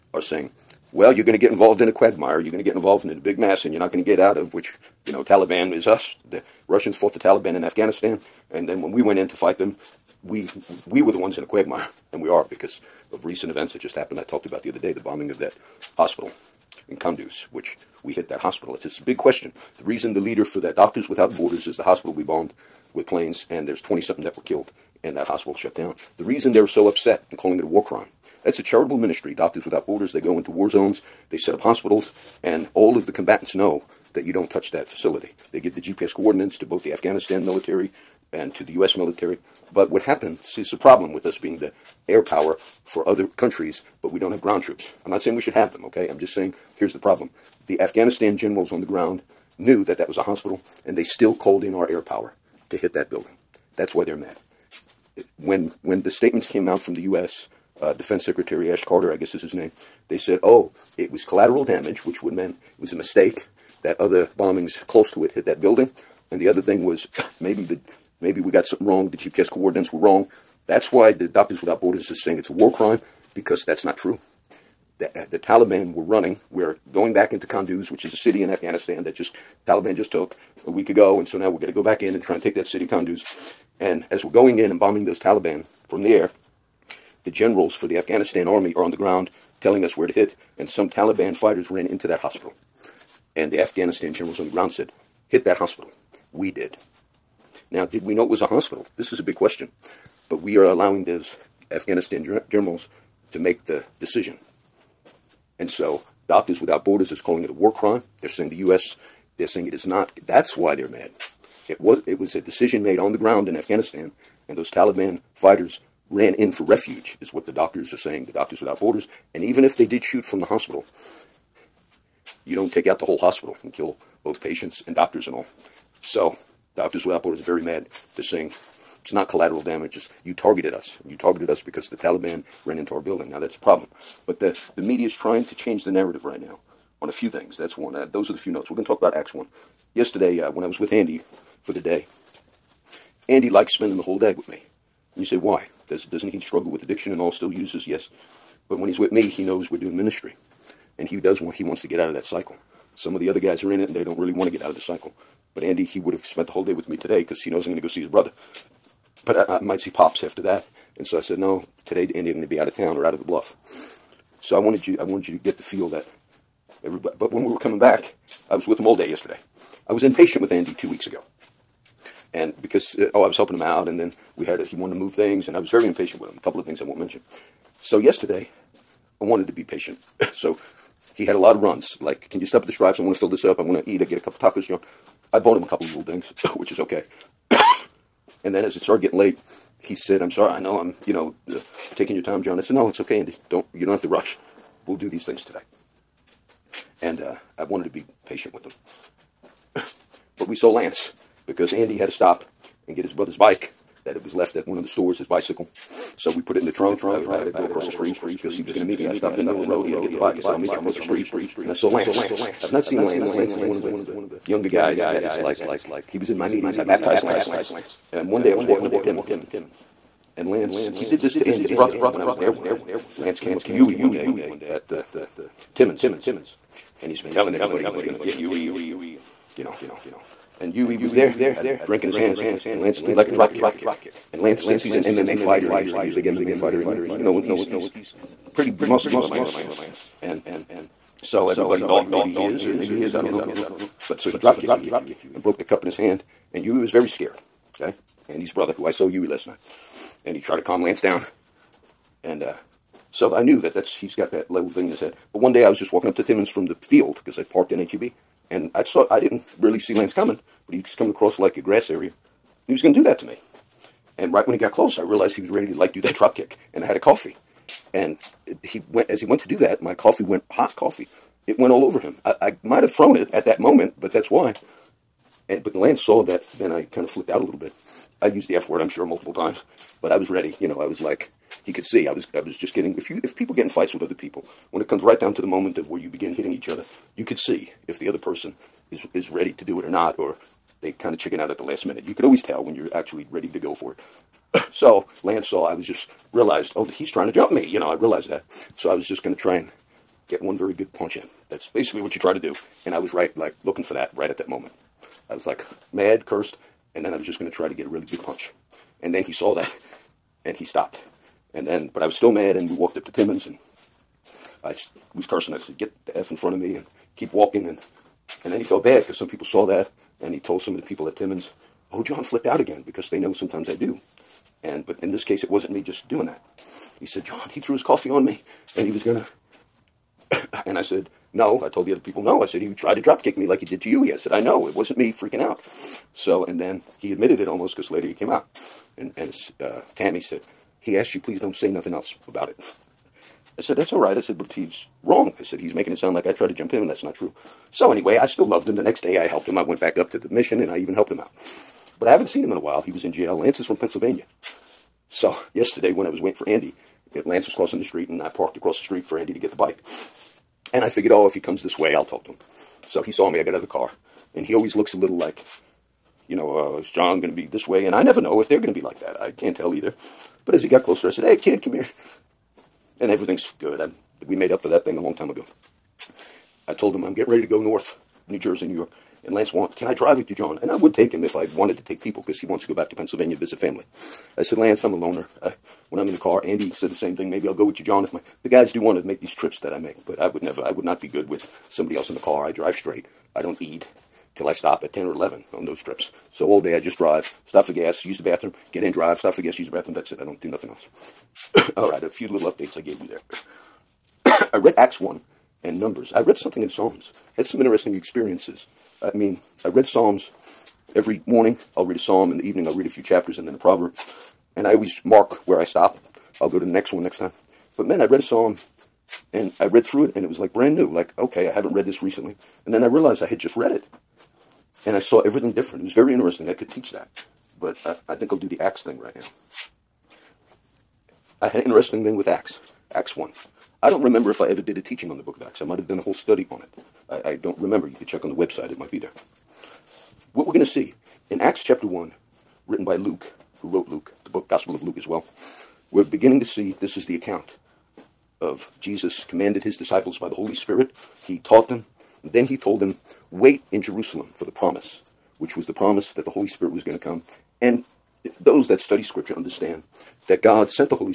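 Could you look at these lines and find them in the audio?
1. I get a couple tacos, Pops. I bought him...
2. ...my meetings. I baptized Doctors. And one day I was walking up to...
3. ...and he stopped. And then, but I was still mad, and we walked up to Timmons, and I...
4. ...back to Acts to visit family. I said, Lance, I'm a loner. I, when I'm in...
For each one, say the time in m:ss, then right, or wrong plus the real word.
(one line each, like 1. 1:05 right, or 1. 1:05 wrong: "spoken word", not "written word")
1. 3:04 wrong: "John", not "Pops"
2. 3:36 wrong: "Lance", not "Doctors"
3. 5:10 right
4. 6:22 wrong: "Pennsylvania", not "Acts".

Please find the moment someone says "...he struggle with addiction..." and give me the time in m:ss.
2:26.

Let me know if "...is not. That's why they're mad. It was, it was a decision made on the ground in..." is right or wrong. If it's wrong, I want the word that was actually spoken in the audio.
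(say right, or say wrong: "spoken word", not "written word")
right.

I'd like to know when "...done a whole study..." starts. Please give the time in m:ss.
7:15.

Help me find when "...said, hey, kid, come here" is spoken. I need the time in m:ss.
6:11.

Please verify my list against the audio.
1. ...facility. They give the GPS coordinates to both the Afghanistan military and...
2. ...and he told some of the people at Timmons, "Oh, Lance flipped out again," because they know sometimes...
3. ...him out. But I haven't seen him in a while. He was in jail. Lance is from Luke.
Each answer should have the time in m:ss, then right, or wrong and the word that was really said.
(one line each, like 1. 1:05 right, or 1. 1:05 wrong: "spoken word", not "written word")
1. 0:34 right
2. 5:20 wrong: "John", not "Lance"
3. 5:51 wrong: "Pennsylvania", not "Luke".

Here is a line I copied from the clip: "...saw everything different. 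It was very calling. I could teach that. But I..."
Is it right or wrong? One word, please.
wrong.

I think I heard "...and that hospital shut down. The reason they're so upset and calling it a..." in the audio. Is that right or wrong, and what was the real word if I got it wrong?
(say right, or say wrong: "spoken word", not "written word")
right.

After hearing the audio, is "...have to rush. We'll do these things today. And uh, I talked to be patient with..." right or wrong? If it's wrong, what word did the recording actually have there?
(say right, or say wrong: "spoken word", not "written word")
wrong: "wanted", not "talked".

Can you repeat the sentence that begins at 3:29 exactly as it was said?
I stopped in the middle of the road.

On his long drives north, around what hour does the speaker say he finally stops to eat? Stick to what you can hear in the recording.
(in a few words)
10 or 11.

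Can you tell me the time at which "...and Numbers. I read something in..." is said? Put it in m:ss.
6:45.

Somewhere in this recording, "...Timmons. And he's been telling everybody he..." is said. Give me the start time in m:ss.
3:45.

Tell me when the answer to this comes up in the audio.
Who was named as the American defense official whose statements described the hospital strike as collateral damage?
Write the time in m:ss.
0:58.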